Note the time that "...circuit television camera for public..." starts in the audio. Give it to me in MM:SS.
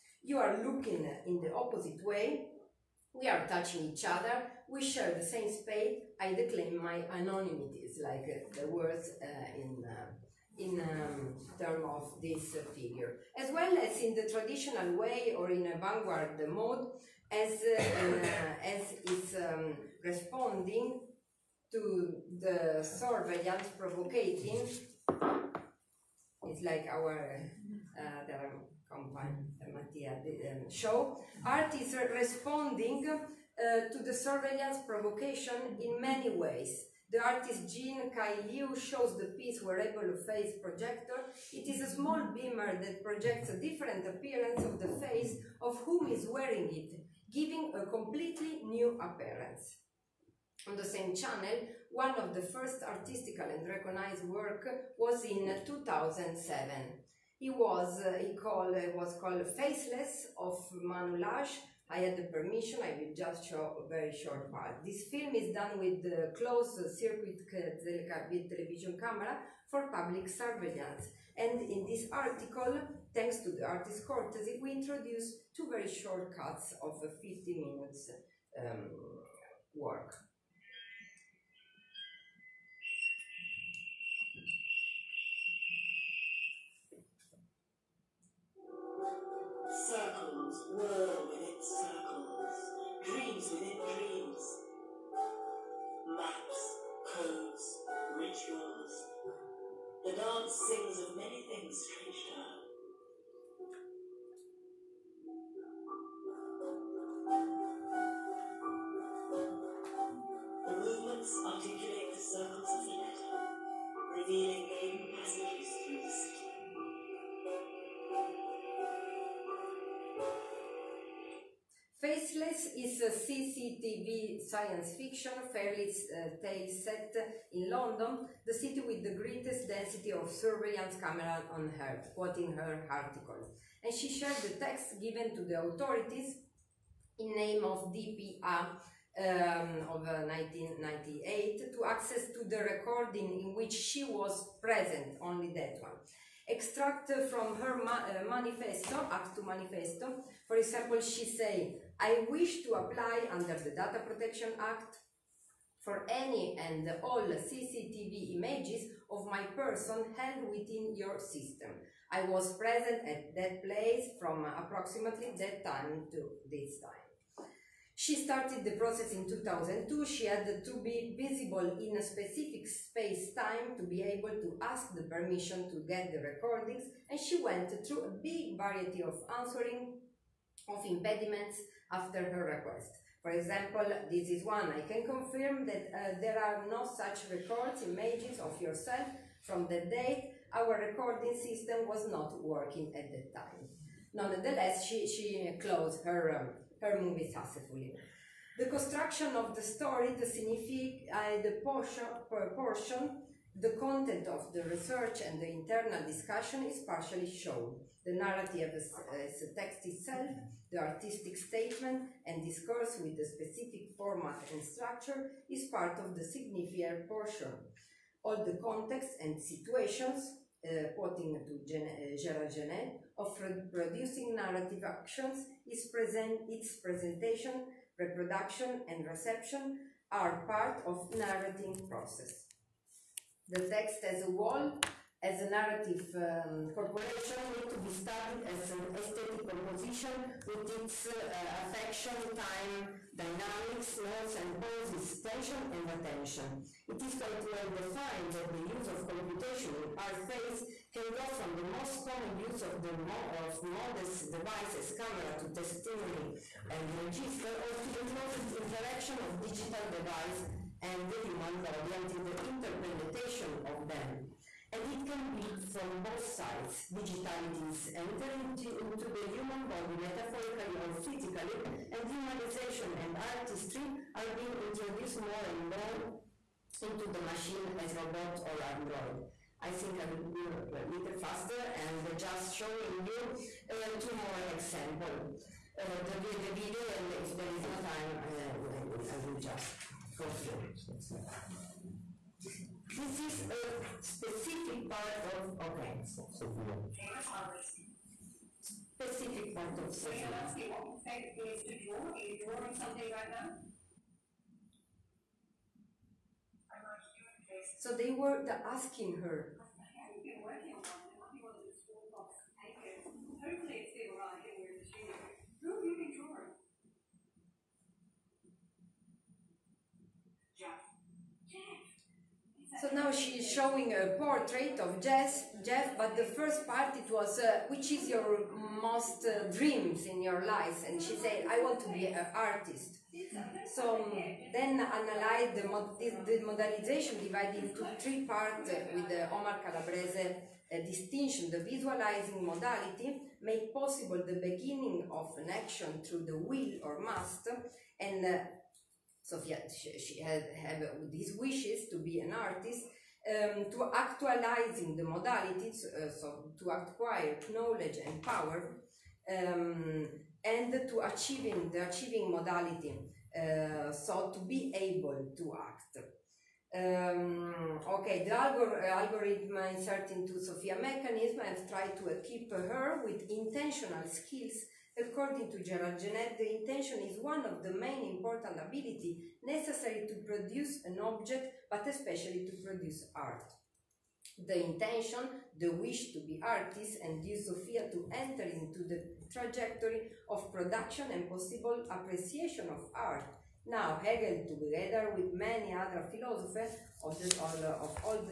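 01:06.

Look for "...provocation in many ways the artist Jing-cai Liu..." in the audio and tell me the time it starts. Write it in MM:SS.
00:34.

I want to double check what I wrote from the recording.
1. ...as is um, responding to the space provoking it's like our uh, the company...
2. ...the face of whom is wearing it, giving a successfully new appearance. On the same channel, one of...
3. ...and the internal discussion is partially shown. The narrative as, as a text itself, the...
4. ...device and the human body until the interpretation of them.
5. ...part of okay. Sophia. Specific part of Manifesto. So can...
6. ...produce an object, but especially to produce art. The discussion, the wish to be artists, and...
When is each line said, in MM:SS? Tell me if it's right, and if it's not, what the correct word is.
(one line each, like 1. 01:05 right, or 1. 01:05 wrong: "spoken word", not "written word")
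1. 00:18 wrong: "surveillance", not "space"
2. 00:44 wrong: "completely", not "successfully"
3. 03:25 right
4. 04:19 right
5. 04:54 wrong: "Sophia", not "Manifesto"
6. 06:20 wrong: "intention", not "discussion".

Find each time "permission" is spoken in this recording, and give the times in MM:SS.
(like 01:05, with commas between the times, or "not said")
01:02, 02:55.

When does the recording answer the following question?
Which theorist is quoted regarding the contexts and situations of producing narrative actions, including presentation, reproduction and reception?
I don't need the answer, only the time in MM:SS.
03:42.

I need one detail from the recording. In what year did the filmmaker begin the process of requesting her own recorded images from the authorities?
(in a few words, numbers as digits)
2002.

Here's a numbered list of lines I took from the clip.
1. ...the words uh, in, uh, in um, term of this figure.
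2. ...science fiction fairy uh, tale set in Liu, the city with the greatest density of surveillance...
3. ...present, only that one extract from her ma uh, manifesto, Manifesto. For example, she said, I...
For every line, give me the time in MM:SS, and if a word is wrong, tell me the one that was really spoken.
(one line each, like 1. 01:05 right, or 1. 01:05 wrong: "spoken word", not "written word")
1. 00:08 right
2. 02:04 wrong: "London", not "Liu"
3. 02:24 right.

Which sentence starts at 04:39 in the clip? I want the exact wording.
I think I will go a little faster and just showing you uh, two more examples.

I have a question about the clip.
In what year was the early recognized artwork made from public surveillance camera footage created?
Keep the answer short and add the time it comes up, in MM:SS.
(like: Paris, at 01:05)
2007, at 00:55.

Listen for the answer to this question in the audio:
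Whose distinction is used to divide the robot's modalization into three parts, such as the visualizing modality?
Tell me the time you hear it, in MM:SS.
05:39.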